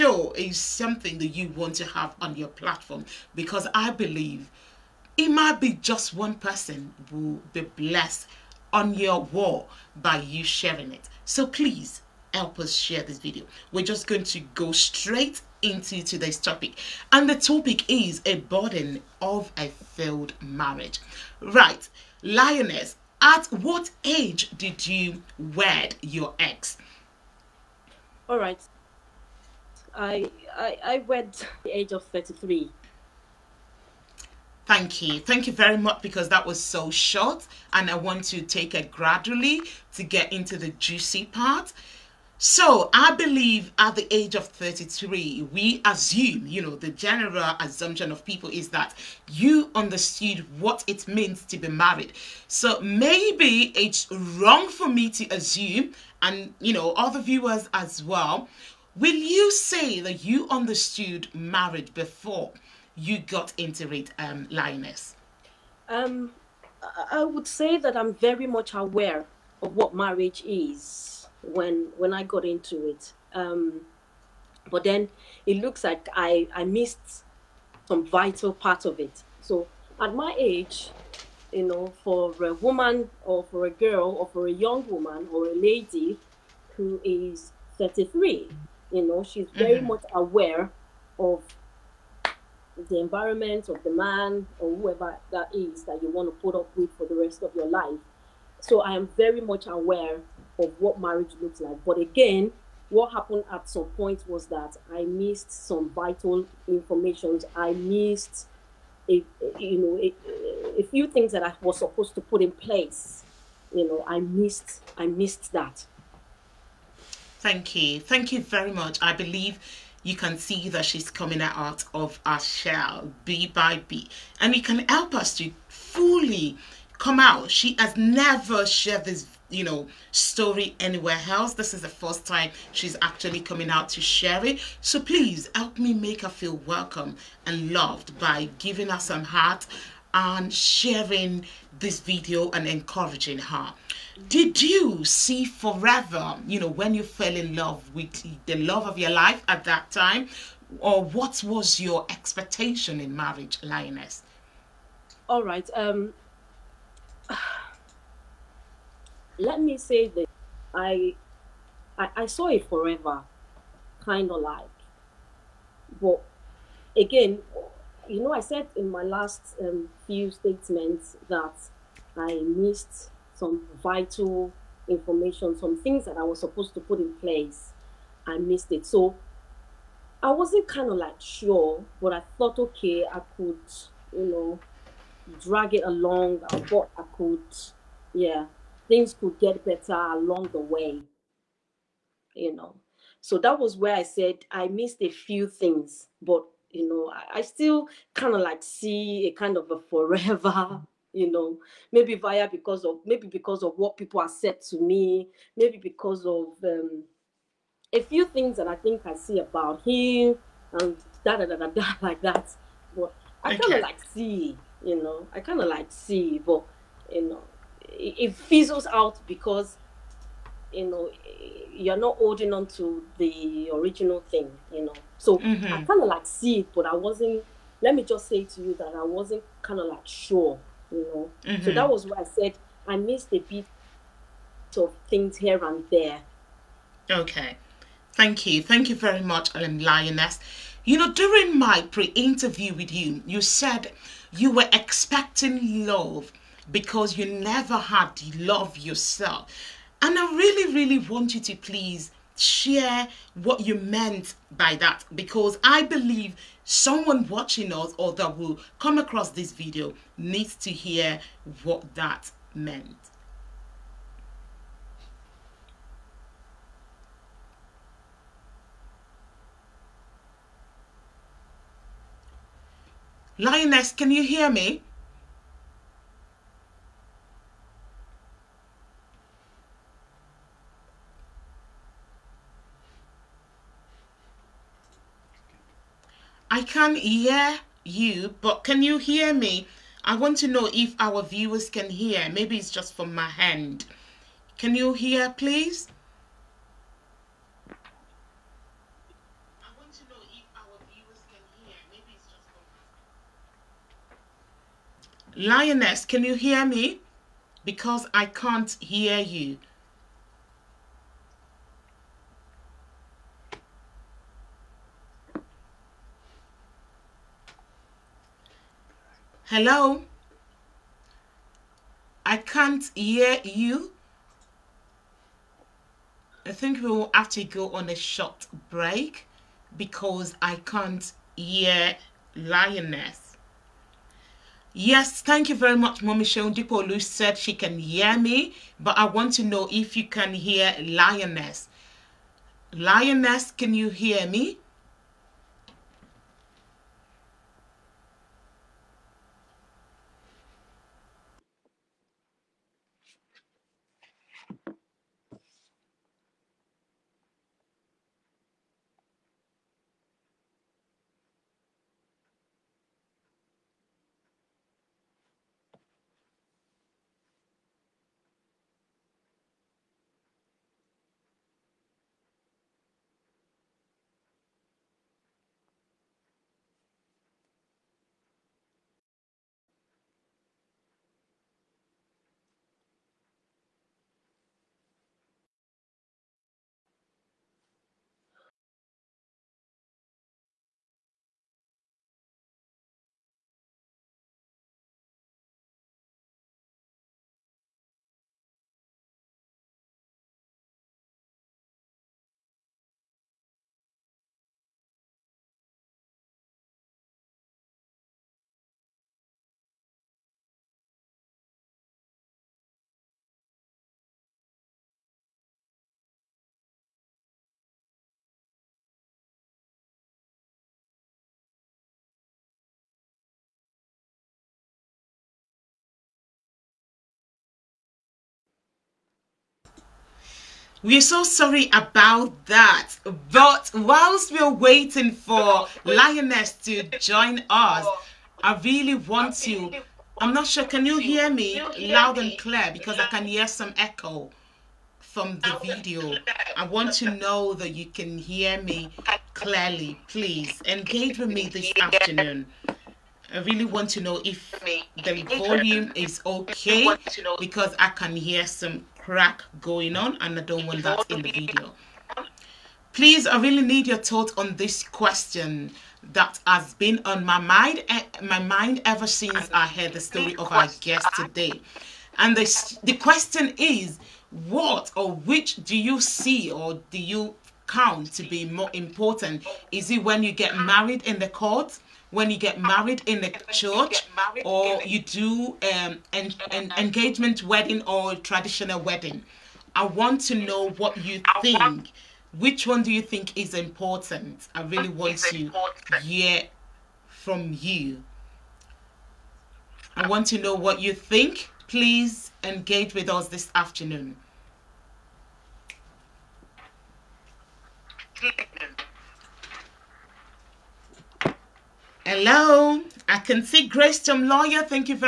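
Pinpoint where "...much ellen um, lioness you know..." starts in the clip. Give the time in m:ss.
3:59.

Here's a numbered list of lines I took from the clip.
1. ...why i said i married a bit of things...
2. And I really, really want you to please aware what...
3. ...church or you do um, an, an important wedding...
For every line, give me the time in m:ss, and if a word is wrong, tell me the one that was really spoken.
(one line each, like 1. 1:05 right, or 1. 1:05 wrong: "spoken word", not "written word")
1. 3:52 wrong: "missed", not "married"
2. 4:10 wrong: "share", not "aware"
3. 8:03 wrong: "engagement", not "important".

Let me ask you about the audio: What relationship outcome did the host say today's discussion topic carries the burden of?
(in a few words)
a failed marriage.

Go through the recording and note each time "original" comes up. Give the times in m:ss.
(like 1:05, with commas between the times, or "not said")
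3:43.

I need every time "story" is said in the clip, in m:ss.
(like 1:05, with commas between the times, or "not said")
2:10, 7:50.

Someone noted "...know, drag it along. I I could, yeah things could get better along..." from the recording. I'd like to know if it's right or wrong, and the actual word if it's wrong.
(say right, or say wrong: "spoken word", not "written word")
right.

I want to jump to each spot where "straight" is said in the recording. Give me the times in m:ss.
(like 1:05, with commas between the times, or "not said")
0:14.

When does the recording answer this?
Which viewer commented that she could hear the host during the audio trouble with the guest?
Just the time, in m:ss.
5:36.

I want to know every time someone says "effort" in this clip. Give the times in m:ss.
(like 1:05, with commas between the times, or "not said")
not said.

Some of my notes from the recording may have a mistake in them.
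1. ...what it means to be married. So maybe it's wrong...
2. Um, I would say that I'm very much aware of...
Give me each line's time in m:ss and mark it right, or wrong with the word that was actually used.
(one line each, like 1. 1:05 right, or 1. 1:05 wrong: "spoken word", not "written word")
1. 0:50 right
2. 1:05 right.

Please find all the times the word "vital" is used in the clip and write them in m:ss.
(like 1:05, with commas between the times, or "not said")
1:18, 1:45, 2:53.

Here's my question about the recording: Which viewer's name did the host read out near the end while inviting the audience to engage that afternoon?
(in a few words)
Grace Tom Lawyer.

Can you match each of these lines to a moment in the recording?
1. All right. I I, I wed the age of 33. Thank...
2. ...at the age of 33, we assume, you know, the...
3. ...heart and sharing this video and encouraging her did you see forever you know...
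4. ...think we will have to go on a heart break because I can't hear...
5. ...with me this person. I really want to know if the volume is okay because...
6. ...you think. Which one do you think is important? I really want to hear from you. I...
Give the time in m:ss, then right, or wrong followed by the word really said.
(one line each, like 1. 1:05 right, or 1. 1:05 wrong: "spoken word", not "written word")
1. 0:28 right
2. 0:43 right
3. 2:19 right
4. 5:26 wrong: "short", not "heart"
5. 7:31 wrong: "afternoon", not "person"
6. 8:11 right.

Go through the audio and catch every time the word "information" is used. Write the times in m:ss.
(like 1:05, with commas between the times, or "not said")
1:46, 2:54.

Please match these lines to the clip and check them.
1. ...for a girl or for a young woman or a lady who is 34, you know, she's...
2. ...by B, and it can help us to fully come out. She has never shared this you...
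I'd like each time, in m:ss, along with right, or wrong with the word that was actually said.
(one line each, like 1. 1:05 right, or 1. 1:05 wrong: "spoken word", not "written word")
1. 1:23 wrong: "33", not "34"
2. 2:03 right.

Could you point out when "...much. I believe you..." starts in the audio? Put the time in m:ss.
1:58.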